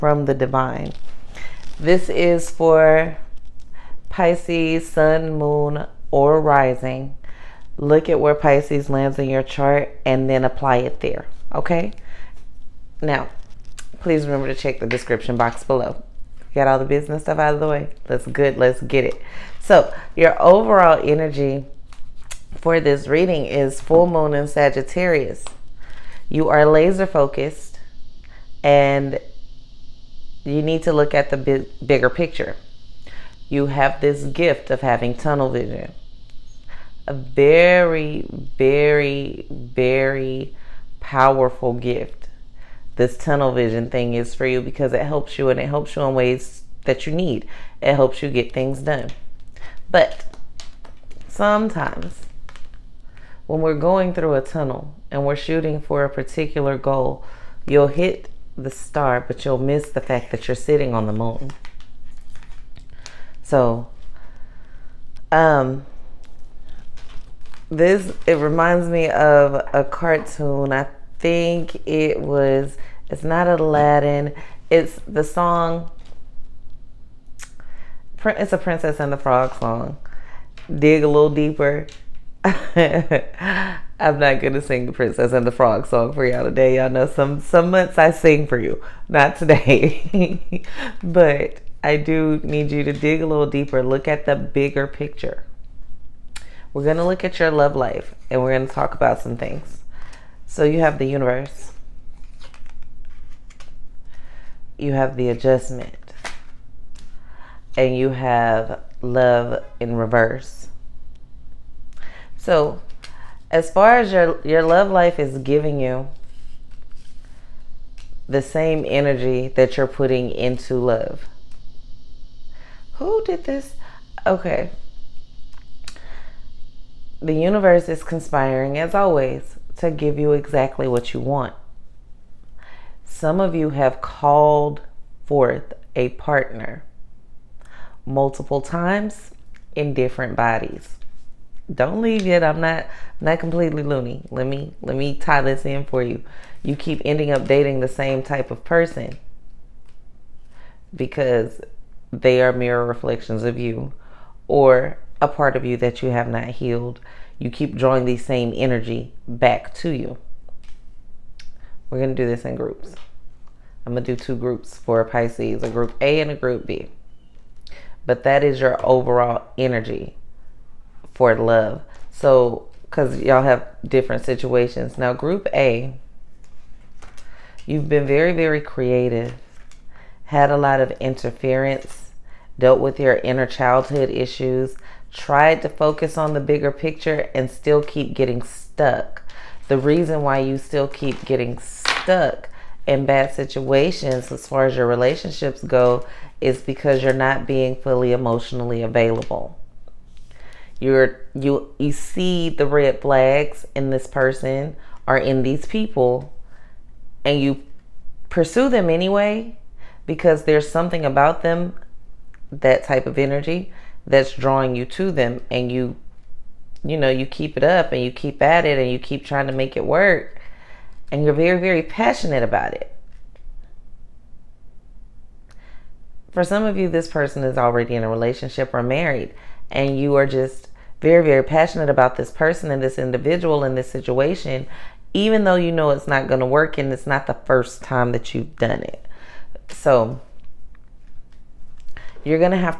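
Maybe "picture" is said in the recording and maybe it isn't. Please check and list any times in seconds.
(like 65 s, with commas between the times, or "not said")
32 s, 94 s, 186 s.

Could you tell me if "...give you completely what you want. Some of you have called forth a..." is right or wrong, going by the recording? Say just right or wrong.
wrong.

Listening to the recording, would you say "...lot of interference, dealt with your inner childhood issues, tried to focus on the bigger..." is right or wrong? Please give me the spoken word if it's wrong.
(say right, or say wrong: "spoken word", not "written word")
right.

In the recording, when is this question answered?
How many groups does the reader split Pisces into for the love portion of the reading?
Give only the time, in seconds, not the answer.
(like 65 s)
164 s.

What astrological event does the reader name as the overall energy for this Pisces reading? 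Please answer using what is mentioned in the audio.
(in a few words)
Full moon in Sagittarius.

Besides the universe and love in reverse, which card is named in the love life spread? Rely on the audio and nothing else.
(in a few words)
The adjustment.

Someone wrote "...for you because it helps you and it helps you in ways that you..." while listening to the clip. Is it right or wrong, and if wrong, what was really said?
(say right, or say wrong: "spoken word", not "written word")
right.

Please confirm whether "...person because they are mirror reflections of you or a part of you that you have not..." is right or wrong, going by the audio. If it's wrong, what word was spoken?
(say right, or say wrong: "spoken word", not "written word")
right.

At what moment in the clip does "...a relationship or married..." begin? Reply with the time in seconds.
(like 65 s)
228 s.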